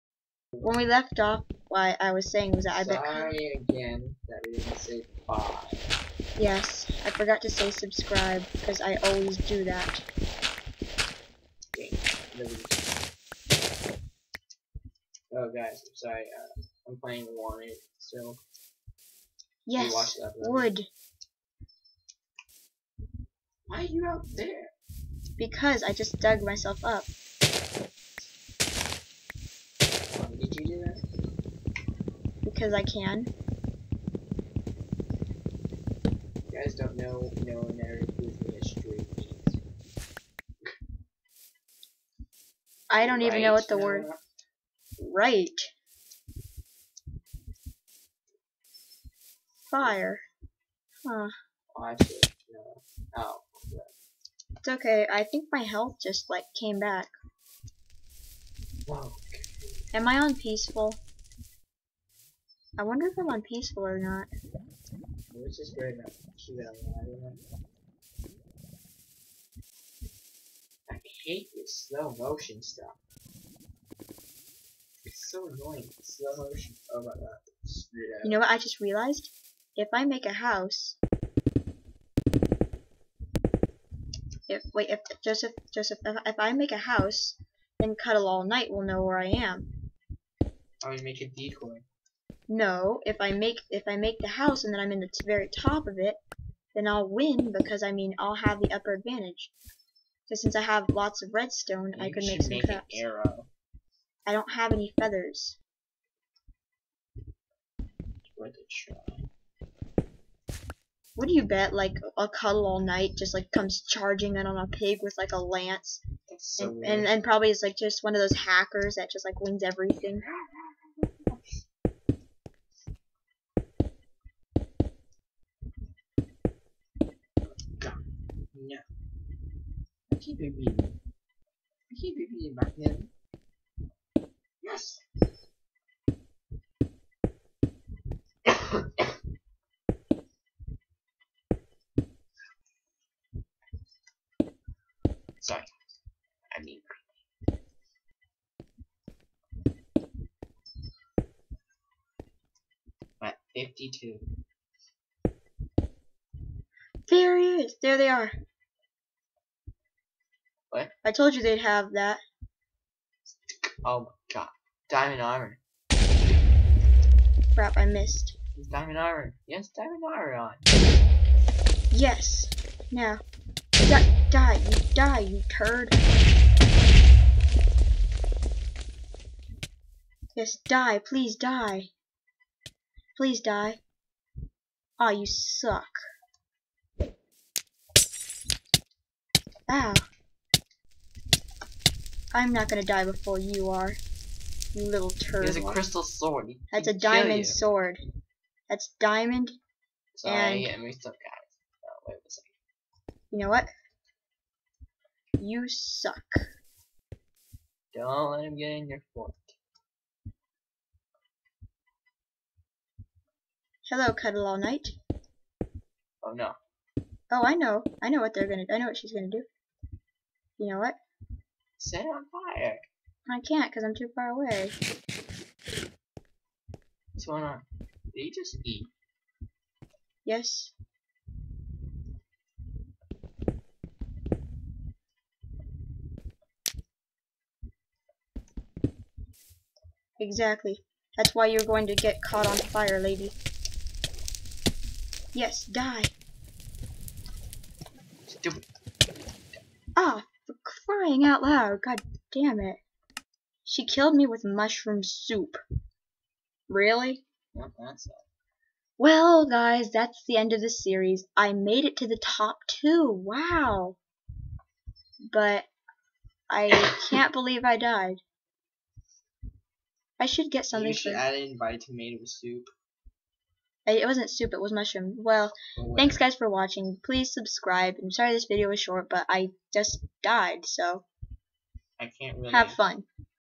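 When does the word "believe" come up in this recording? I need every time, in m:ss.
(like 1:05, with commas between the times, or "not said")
4:27.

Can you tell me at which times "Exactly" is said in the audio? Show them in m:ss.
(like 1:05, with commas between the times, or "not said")
4:00.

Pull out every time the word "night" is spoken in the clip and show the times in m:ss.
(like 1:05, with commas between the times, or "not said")
1:28, 1:52, 3:34.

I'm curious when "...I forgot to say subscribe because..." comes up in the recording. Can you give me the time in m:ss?
0:07.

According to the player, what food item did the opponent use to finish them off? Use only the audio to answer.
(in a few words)
mushroom soup.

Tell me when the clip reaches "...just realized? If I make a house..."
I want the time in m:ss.
1:18.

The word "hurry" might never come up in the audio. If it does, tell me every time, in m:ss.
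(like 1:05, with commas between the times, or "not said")
not said.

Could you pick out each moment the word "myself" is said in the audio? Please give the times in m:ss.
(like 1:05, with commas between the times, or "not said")
0:26.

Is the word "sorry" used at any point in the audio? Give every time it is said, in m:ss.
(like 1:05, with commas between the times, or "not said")
0:03, 0:15, 2:25, 3:20, 4:38.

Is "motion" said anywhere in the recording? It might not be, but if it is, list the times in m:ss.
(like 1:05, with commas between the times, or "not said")
1:12, 1:16.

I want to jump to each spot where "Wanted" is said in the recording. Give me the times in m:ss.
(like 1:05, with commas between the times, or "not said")
0:17.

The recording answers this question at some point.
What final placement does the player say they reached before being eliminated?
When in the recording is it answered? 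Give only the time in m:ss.
4:22.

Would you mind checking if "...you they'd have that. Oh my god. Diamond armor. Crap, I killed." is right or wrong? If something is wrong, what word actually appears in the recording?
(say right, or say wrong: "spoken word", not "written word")
wrong: "missed", not "killed".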